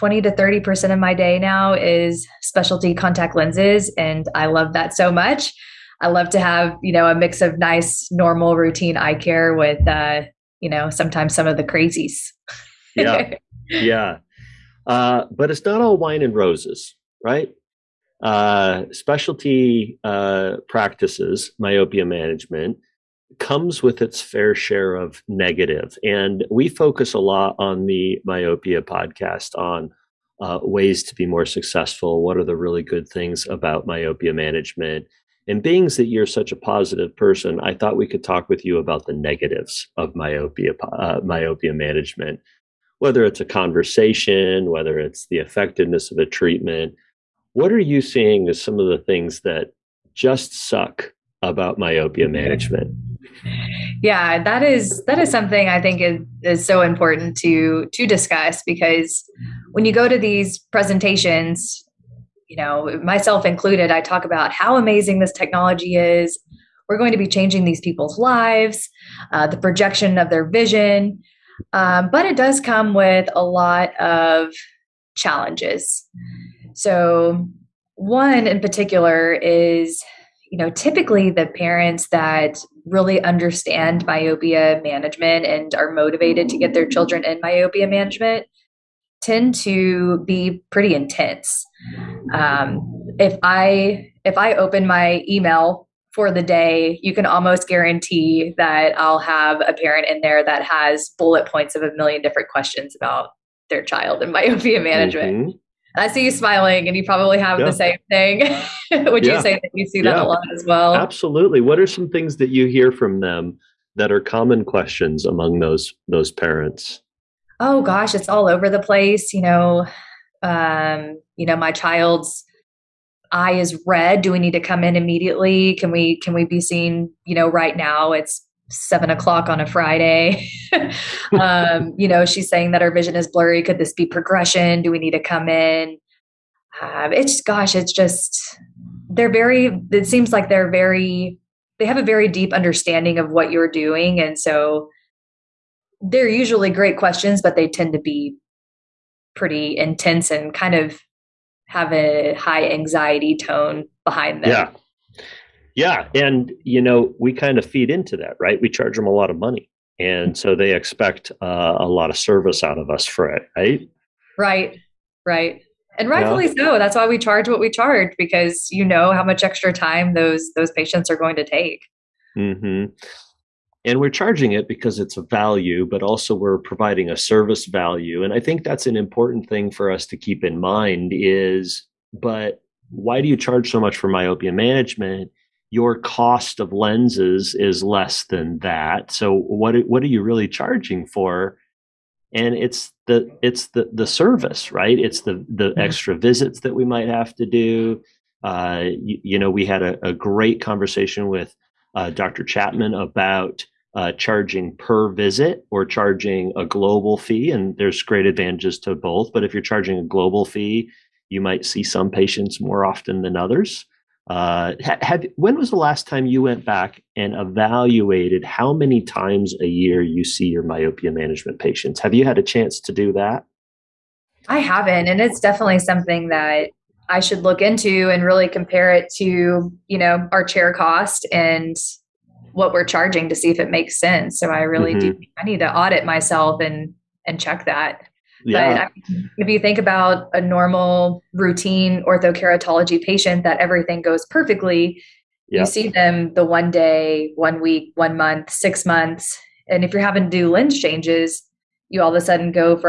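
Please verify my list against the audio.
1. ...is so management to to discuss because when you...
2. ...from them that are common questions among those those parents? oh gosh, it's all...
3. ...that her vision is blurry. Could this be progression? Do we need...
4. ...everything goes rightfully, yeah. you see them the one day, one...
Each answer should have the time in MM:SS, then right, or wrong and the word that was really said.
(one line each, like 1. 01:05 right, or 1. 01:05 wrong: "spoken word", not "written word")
1. 00:56 wrong: "important", not "management"
2. 01:52 right
3. 02:12 right
4. 04:03 wrong: "perfectly", not "rightfully".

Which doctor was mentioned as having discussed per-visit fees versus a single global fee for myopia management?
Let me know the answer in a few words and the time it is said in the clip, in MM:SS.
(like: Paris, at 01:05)
Dr. Chapman, at 03:22.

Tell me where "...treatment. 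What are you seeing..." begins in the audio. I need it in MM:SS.
00:46.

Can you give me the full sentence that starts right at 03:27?
And there's great advantages to both.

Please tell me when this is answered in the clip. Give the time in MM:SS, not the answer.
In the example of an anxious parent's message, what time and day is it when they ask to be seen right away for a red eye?
02:08.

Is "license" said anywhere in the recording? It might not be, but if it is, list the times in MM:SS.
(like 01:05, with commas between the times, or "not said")
not said.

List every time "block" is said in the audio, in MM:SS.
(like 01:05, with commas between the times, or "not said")
not said.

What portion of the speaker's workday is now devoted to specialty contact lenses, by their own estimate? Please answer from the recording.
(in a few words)
30%.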